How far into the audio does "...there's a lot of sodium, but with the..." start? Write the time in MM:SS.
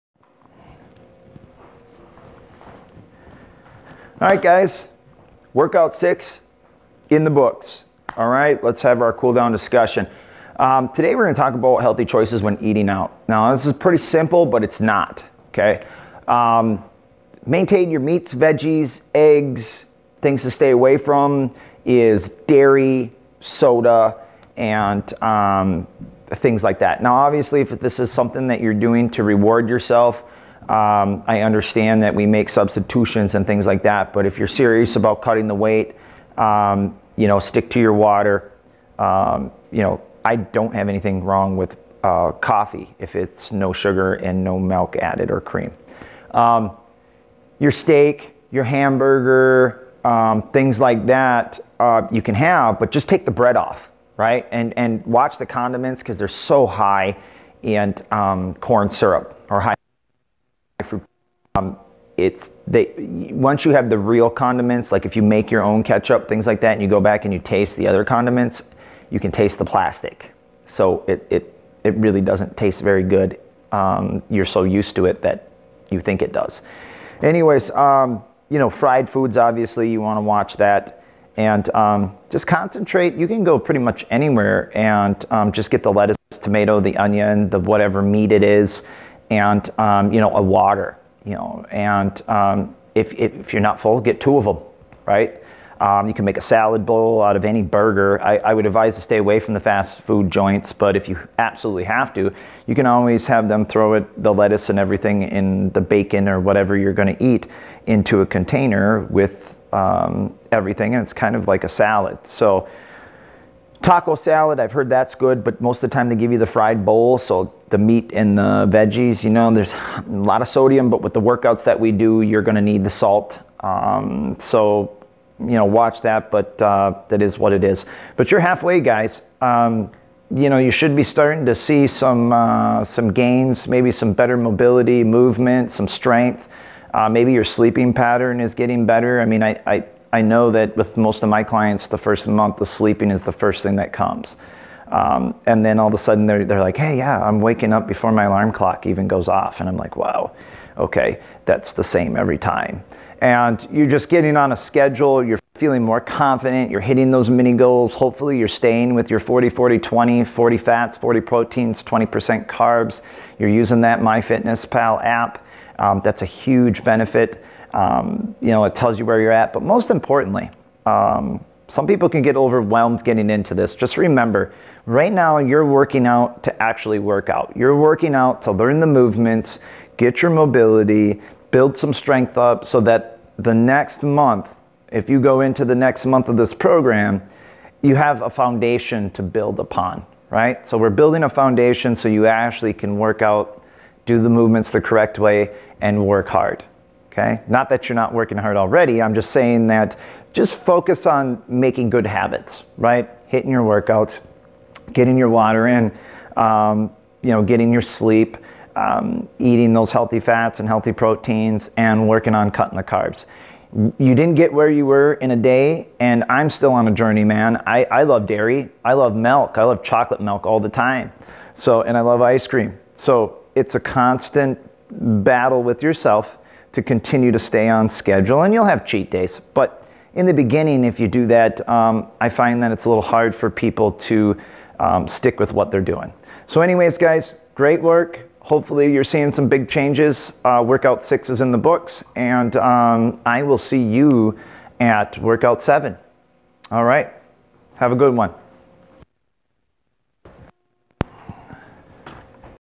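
01:59.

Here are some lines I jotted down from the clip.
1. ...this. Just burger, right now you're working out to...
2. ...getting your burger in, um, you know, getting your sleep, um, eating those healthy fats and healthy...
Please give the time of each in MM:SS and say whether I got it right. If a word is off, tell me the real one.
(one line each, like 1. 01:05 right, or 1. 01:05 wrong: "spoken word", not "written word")
1. 02:53 wrong: "remember", not "burger"
2. 03:24 wrong: "water", not "burger".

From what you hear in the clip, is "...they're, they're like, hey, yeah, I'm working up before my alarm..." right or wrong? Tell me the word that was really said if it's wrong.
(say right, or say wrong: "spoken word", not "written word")
wrong: "waking", not "working".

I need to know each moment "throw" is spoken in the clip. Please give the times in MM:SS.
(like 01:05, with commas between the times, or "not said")
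01:43.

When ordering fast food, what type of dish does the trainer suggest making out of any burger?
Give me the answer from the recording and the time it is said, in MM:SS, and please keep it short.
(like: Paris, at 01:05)
salad bowl, at 01:36.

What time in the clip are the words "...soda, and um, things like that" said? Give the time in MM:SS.
00:23.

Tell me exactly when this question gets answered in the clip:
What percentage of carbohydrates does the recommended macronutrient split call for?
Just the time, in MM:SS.
02:41.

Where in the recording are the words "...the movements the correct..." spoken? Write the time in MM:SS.
03:14.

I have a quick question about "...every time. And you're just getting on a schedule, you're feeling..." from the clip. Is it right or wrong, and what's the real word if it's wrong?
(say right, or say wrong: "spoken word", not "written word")
right.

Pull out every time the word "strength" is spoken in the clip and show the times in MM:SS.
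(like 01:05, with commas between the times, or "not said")
02:15, 03:01.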